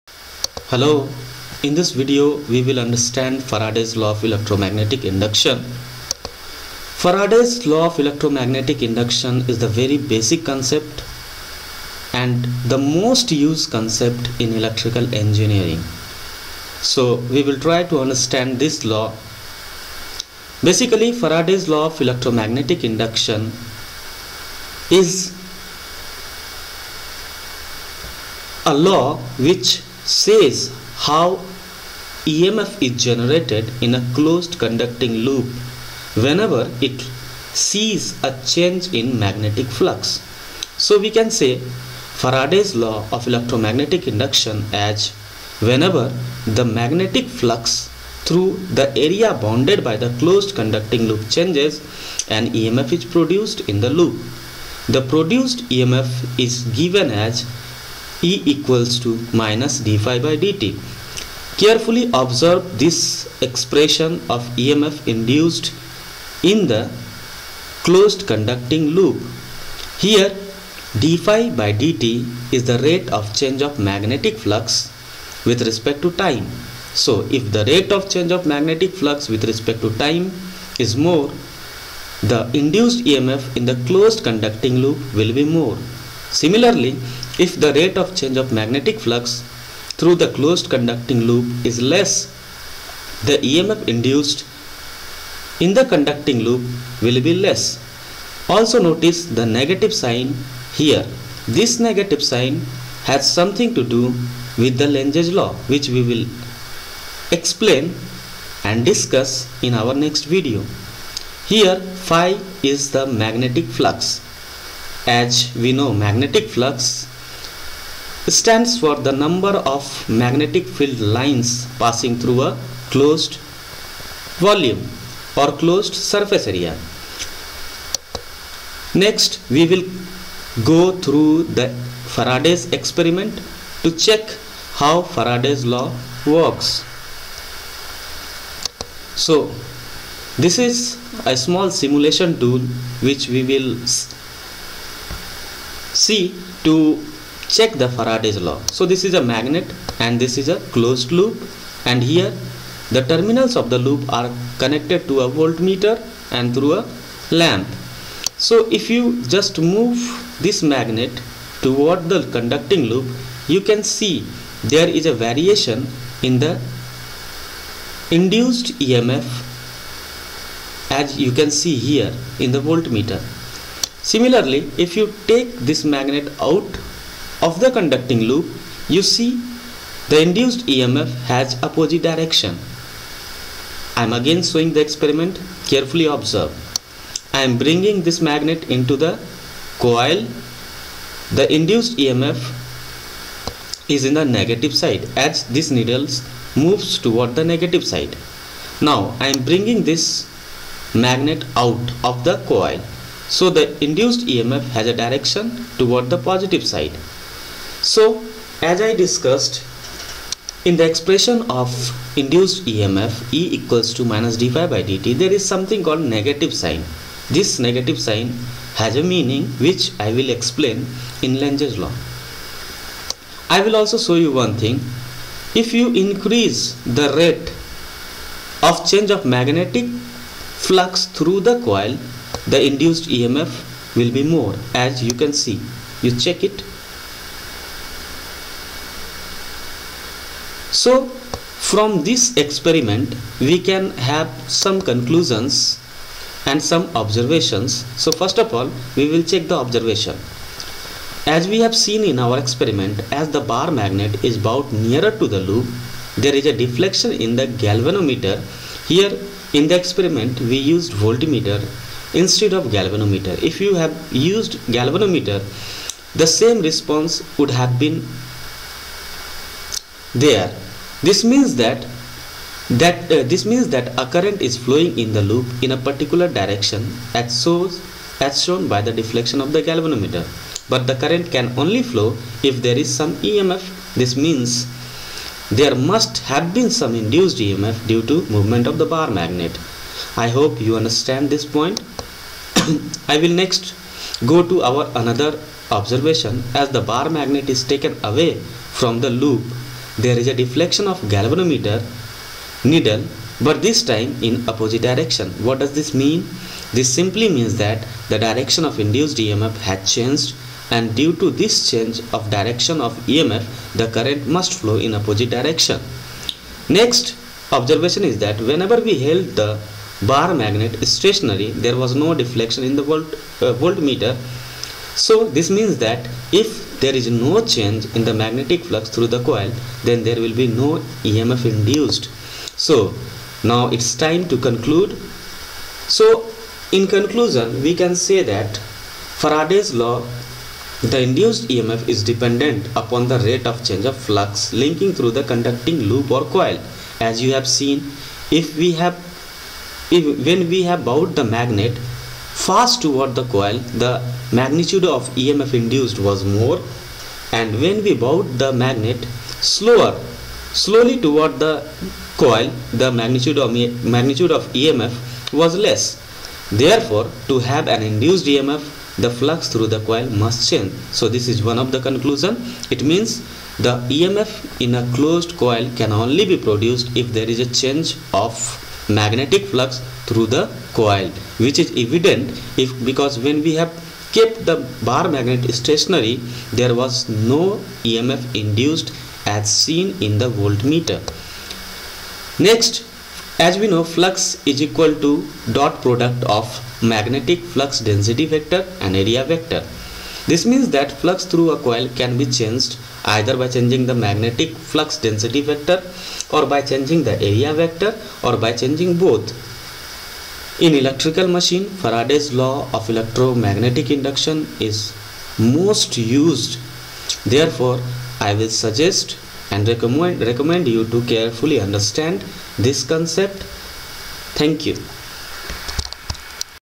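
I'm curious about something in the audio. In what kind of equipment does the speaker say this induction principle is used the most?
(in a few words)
electrical machine.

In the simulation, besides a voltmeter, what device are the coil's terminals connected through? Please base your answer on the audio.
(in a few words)
a lamp.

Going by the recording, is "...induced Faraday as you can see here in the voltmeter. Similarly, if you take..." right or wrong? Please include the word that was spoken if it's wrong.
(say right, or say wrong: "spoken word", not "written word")
wrong: "EMF", not "Faraday".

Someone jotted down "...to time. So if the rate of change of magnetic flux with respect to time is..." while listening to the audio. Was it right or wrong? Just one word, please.
right.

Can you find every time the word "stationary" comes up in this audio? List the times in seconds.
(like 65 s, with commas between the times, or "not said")
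320 s, 385 s.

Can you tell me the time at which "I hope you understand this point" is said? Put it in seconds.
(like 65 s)
290 s.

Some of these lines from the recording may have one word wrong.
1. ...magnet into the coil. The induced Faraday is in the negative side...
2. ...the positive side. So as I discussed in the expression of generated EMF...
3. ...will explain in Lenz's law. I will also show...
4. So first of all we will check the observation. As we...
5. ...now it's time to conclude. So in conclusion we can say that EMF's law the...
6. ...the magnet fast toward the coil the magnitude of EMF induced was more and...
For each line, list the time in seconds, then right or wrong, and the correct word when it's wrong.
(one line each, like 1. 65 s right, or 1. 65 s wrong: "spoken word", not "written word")
1. 188 s wrong: "EMF", not "Faraday"
2. 206 s wrong: "induced", not "generated"
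3. 220 s right
4. 248 s right
5. 333 s wrong: "Faraday", not "EMF"
6. 351 s right.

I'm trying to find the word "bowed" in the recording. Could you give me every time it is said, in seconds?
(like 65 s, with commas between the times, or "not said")
254 s, 350 s, 358 s.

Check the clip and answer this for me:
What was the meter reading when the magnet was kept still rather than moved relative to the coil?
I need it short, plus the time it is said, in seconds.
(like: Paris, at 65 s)
no deflection, at 321 s.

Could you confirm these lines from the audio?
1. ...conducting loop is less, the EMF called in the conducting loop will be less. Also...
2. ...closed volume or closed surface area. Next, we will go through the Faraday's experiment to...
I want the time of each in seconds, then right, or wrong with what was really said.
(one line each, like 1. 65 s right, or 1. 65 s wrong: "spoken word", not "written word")
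1. 90 s wrong: "induced", not "called"
2. 122 s right.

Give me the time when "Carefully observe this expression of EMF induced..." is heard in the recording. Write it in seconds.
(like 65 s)
61 s.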